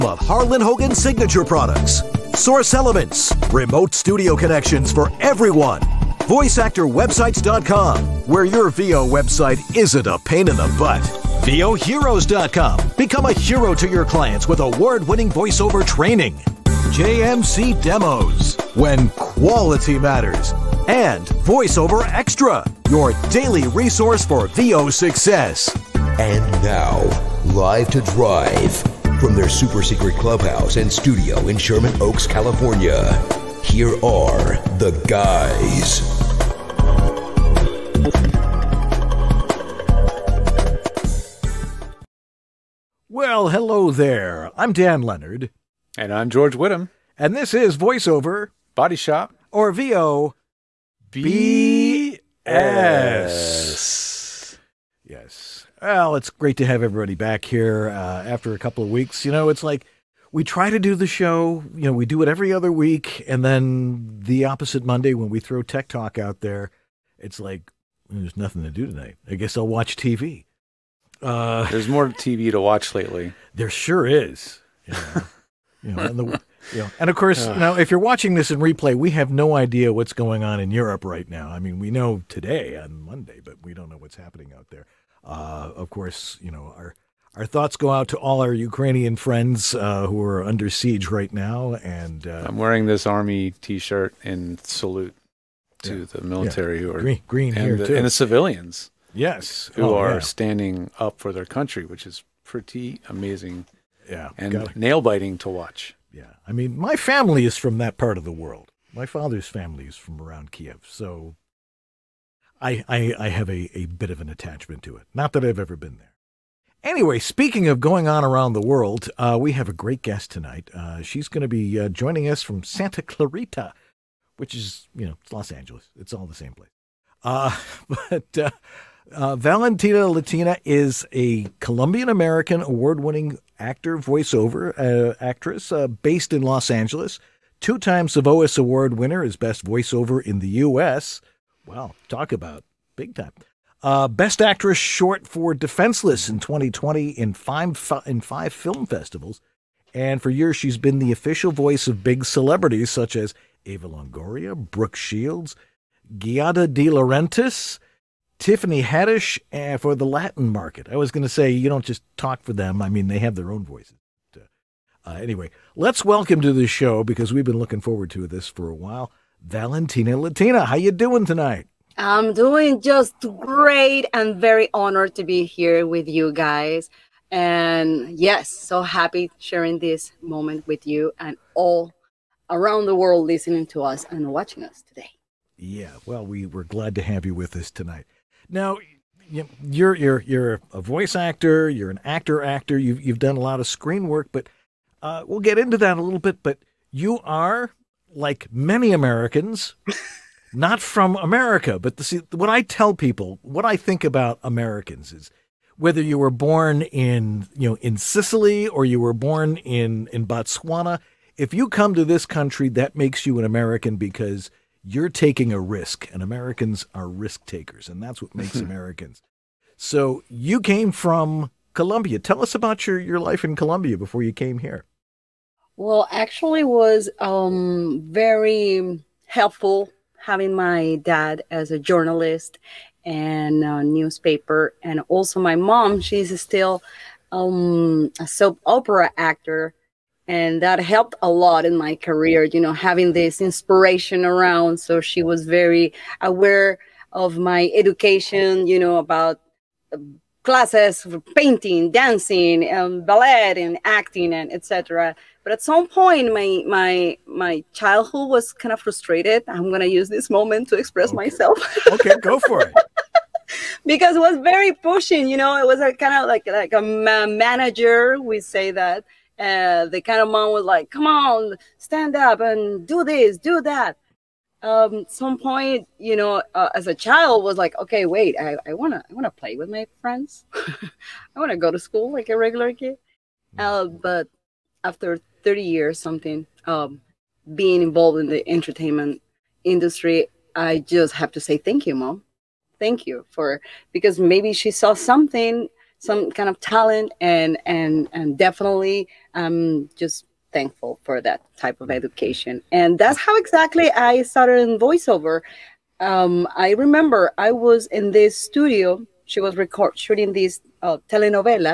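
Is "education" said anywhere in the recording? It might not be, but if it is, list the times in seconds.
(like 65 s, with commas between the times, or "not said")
247 s, 301 s.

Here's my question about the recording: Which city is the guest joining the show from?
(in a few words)
Santa Clarita.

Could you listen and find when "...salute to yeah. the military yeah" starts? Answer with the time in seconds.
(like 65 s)
94 s.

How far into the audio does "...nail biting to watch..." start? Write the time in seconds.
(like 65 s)
104 s.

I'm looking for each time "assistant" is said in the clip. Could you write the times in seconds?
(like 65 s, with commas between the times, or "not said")
not said.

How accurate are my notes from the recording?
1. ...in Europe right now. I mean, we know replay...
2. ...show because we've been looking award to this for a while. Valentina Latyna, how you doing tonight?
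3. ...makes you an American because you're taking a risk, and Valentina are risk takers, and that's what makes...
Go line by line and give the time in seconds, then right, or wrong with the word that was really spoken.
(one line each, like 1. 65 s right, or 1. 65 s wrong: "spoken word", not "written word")
1. 80 s wrong: "today", not "replay"
2. 166 s wrong: "forward", not "award"
3. 212 s wrong: "Americans", not "Valentina".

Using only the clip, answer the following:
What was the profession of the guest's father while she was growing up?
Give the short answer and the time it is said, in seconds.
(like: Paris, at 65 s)
Journalist, at 231 s.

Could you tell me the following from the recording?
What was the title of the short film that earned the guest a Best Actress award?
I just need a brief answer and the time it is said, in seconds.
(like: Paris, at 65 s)
Defenseless, at 145 s.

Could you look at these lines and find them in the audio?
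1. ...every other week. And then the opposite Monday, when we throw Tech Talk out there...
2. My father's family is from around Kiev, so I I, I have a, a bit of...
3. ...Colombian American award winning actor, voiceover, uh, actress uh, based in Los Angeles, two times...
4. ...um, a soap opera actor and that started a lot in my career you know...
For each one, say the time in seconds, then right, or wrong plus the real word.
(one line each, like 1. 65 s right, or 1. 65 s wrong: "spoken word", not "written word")
1. 62 s right
2. 108 s right
3. 131 s right
4. 237 s wrong: "helped", not "started".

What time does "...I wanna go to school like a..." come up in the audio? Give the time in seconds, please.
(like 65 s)
280 s.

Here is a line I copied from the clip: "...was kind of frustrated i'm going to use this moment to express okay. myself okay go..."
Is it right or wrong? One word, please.
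right.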